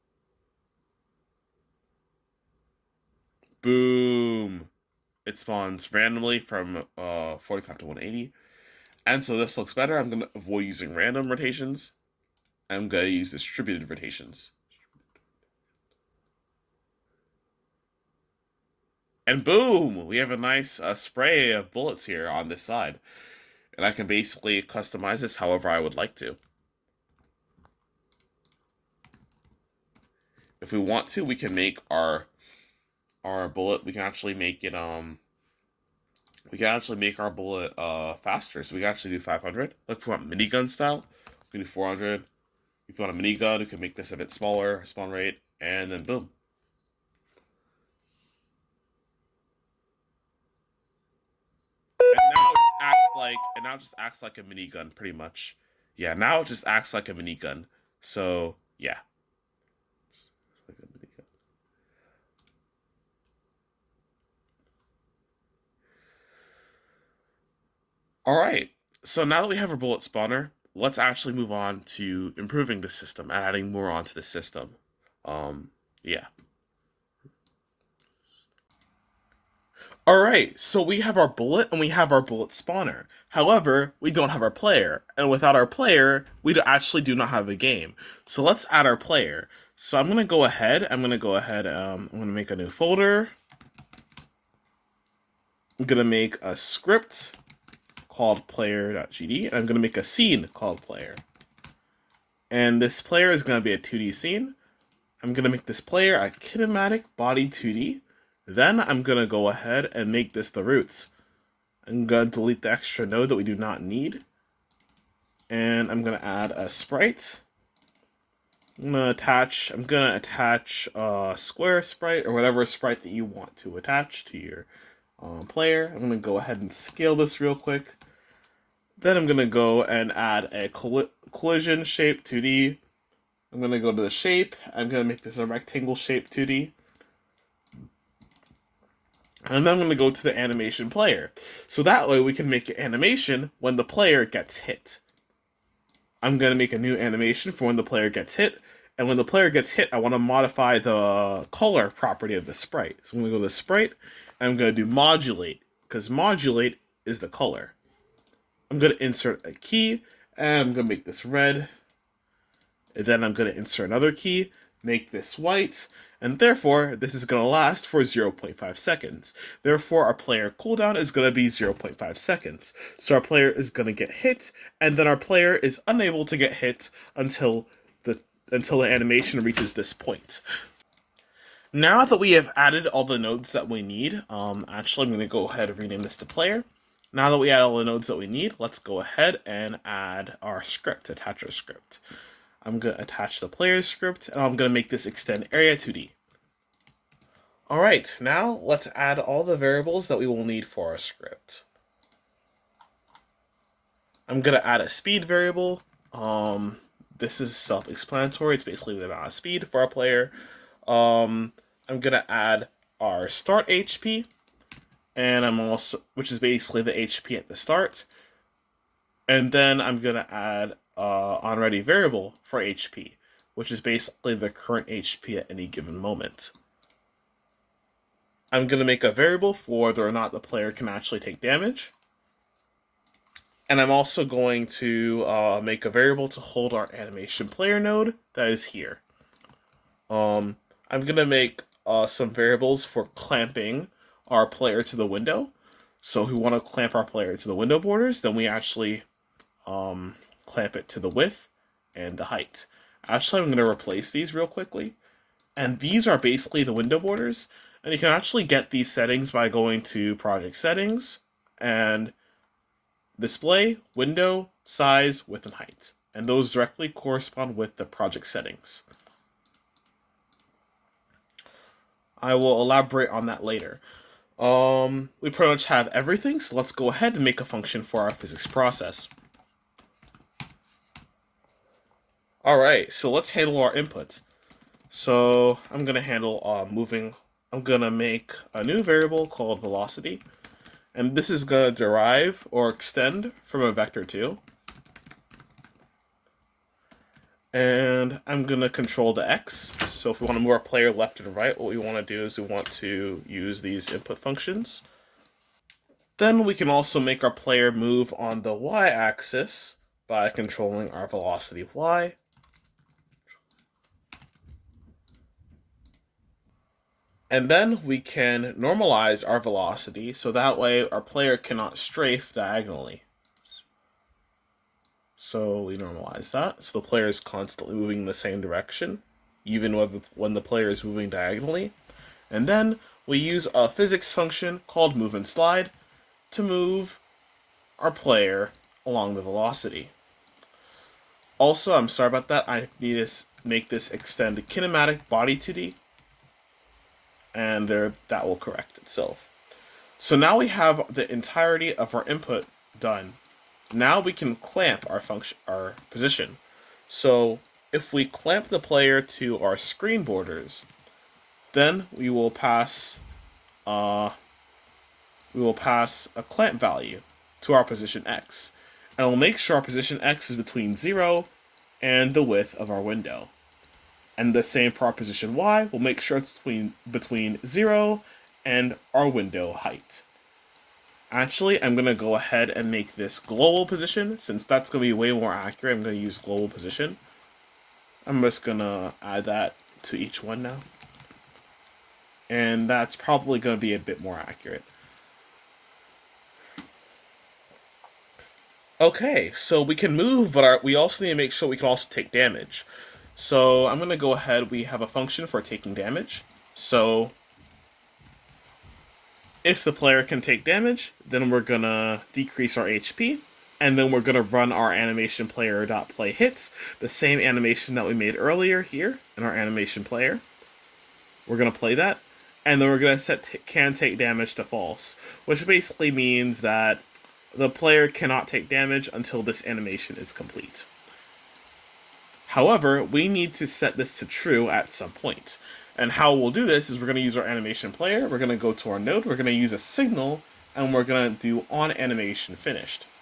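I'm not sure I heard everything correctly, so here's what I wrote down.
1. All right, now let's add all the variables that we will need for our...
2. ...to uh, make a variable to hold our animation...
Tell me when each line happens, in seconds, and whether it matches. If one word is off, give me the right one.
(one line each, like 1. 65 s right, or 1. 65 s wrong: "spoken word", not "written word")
1. 197 s right
2. 234 s right.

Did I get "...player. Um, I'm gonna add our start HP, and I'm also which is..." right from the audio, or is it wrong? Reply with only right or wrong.
right.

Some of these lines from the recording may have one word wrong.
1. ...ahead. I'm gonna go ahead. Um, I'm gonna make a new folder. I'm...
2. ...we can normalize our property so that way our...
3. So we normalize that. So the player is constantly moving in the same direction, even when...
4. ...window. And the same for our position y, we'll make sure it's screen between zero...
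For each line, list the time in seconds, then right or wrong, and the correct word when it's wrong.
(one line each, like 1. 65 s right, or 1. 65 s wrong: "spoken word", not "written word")
1. 90 s right
2. 317 s wrong: "velocity", not "property"
3. 325 s right
4. 372 s wrong: "between", not "screen".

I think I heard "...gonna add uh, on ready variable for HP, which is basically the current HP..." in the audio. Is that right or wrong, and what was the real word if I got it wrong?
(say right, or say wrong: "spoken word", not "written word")
right.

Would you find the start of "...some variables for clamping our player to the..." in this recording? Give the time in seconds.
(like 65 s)
242 s.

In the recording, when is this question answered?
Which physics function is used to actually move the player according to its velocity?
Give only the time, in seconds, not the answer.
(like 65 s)
334 s.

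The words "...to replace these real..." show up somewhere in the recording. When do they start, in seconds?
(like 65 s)
253 s.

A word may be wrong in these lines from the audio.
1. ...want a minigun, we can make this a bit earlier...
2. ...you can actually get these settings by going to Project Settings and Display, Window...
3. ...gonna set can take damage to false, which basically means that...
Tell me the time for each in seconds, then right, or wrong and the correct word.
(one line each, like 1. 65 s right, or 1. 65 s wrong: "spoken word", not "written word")
1. 43 s wrong: "smaller", not "earlier"
2. 257 s right
3. 422 s right.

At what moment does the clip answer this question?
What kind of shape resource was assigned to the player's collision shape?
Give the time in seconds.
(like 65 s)
135 s.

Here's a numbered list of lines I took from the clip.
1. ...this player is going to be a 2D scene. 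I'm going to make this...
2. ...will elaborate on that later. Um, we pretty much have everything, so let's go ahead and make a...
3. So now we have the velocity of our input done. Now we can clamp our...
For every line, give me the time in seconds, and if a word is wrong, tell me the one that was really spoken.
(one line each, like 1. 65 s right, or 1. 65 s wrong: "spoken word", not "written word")
1. 102 s right
2. 272 s right
3. 349 s wrong: "entirety", not "velocity".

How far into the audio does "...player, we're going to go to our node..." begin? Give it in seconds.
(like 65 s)
437 s.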